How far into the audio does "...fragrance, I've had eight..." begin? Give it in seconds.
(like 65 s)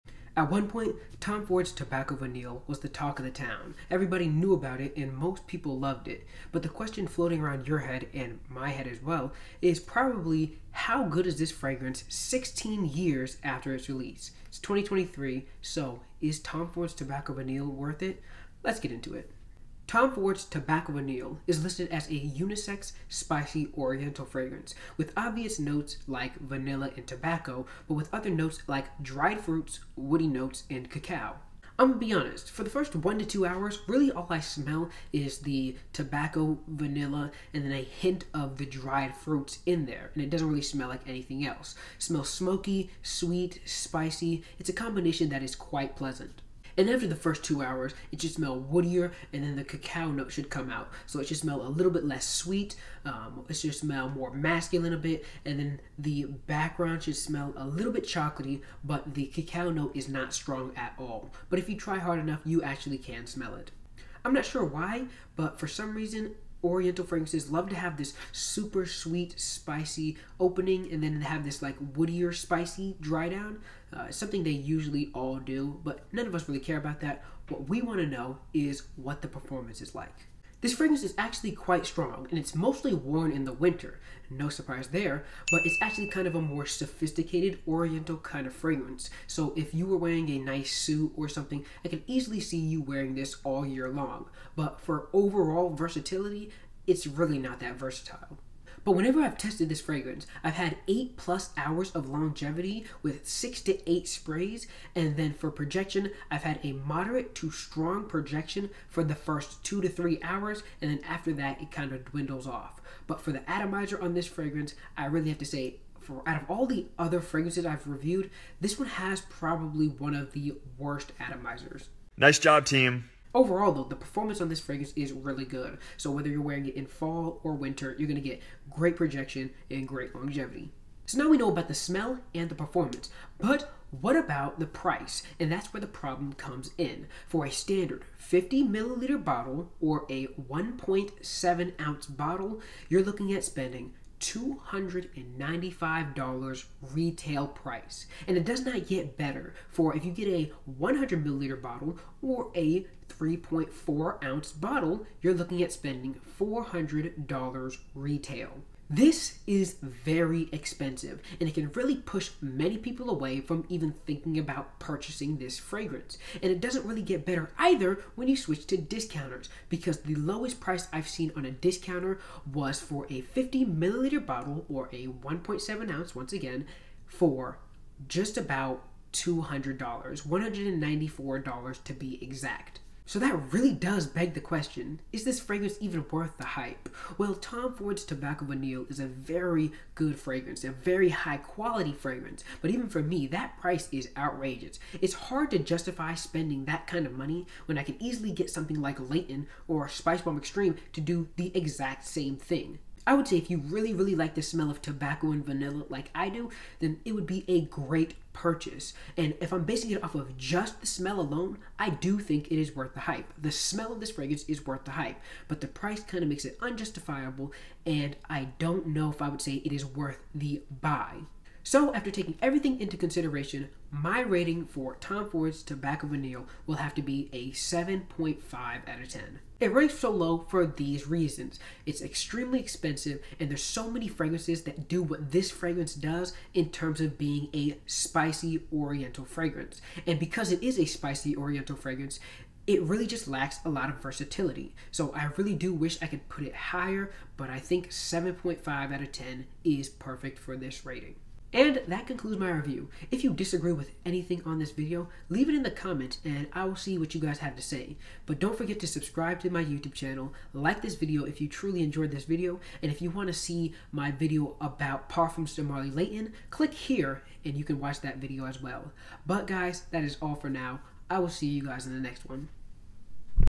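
99 s.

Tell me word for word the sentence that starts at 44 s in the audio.
It's a combination that is quite pleasant.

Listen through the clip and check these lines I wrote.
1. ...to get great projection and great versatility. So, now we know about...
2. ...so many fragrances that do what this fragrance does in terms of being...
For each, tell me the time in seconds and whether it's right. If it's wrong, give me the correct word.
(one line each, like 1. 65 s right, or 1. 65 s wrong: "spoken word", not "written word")
1. 128 s wrong: "longevity", not "versatility"
2. 233 s right.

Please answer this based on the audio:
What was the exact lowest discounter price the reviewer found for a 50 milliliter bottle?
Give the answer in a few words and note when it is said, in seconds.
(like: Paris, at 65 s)
$194, at 180 s.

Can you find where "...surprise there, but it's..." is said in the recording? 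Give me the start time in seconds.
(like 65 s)
84 s.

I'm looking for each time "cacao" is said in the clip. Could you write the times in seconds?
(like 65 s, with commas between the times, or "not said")
30 s, 49 s, 59 s.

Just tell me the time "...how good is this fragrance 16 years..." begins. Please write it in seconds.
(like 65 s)
10 s.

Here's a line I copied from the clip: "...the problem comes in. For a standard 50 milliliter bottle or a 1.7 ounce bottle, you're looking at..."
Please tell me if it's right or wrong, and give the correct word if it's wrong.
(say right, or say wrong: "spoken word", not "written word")
right.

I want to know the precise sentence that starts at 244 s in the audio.
So I really do wish I could put it higher, but I think 7.5 out of 10 is perfect for this rating.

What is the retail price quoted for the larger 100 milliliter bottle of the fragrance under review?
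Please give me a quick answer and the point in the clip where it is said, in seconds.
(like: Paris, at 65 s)
$400, at 156 s.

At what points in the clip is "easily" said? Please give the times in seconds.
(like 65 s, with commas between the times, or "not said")
92 s, 198 s.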